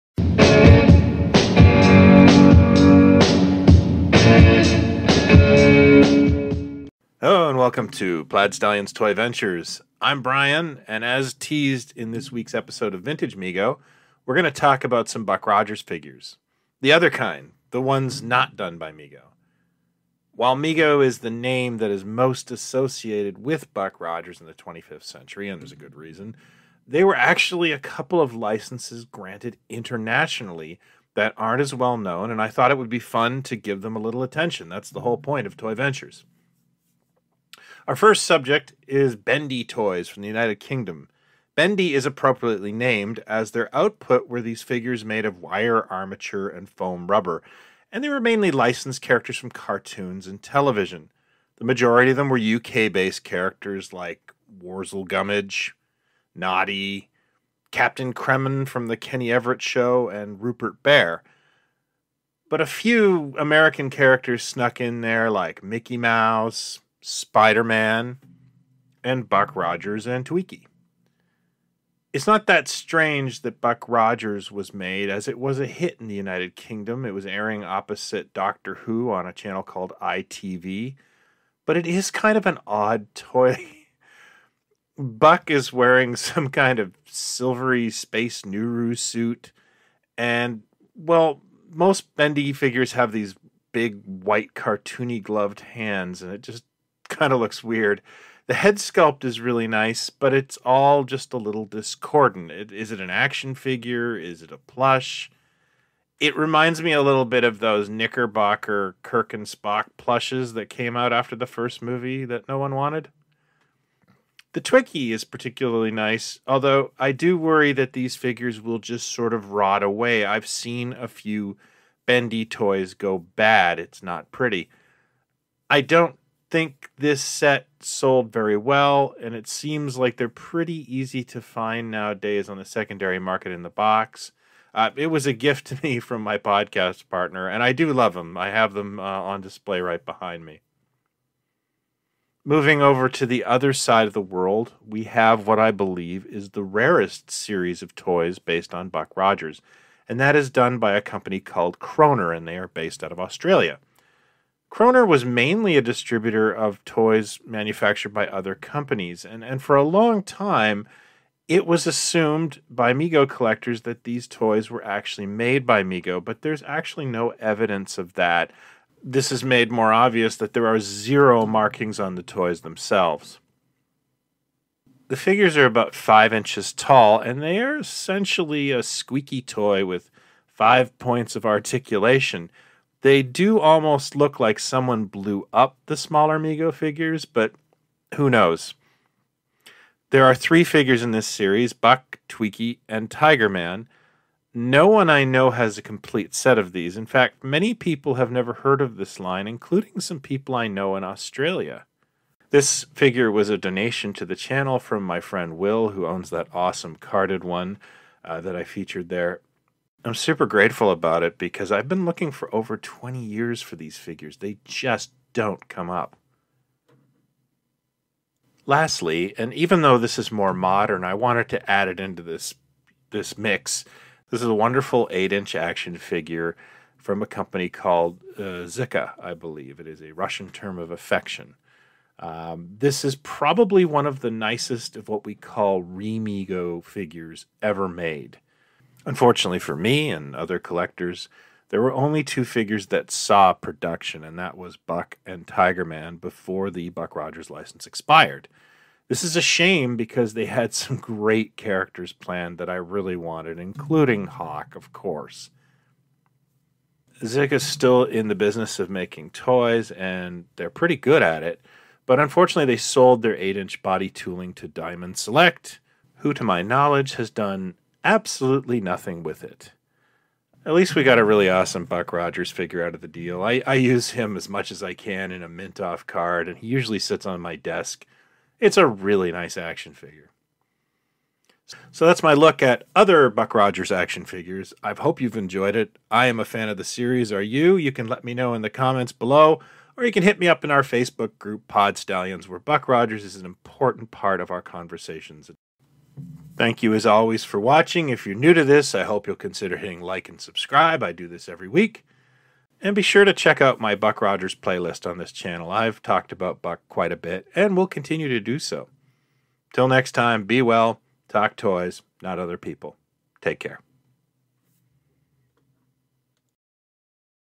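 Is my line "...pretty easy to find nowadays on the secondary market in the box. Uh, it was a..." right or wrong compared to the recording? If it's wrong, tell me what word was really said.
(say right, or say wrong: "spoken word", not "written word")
right.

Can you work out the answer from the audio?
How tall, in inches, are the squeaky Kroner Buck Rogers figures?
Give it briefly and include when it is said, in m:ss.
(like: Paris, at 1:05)
5 inches, at 2:55.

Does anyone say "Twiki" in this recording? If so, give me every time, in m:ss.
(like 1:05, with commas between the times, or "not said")
1:10, 1:54, 3:12.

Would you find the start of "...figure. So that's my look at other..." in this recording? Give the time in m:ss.
4:39.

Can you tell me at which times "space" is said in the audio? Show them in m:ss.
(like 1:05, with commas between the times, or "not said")
1:27.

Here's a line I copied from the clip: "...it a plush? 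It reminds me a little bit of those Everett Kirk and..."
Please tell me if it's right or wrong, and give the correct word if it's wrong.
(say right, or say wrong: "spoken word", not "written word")
wrong: "Knickerbocker", not "Everett".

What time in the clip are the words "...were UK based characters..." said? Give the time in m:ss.
0:52.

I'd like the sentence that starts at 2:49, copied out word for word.
This is made more obvious that there are zero markings on the toys themselves.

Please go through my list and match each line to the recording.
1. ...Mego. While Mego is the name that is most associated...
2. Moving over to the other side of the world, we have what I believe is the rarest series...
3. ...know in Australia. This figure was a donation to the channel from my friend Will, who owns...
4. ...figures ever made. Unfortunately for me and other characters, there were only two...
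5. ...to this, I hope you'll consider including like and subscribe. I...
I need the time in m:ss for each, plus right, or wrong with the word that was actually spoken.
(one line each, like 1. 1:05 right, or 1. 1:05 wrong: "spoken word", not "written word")
1. 0:18 right
2. 2:22 right
3. 3:20 right
4. 3:56 wrong: "collectors", not "characters"
5. 4:58 wrong: "hitting", not "including".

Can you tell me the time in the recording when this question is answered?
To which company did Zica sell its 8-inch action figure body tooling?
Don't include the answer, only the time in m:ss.
4:24.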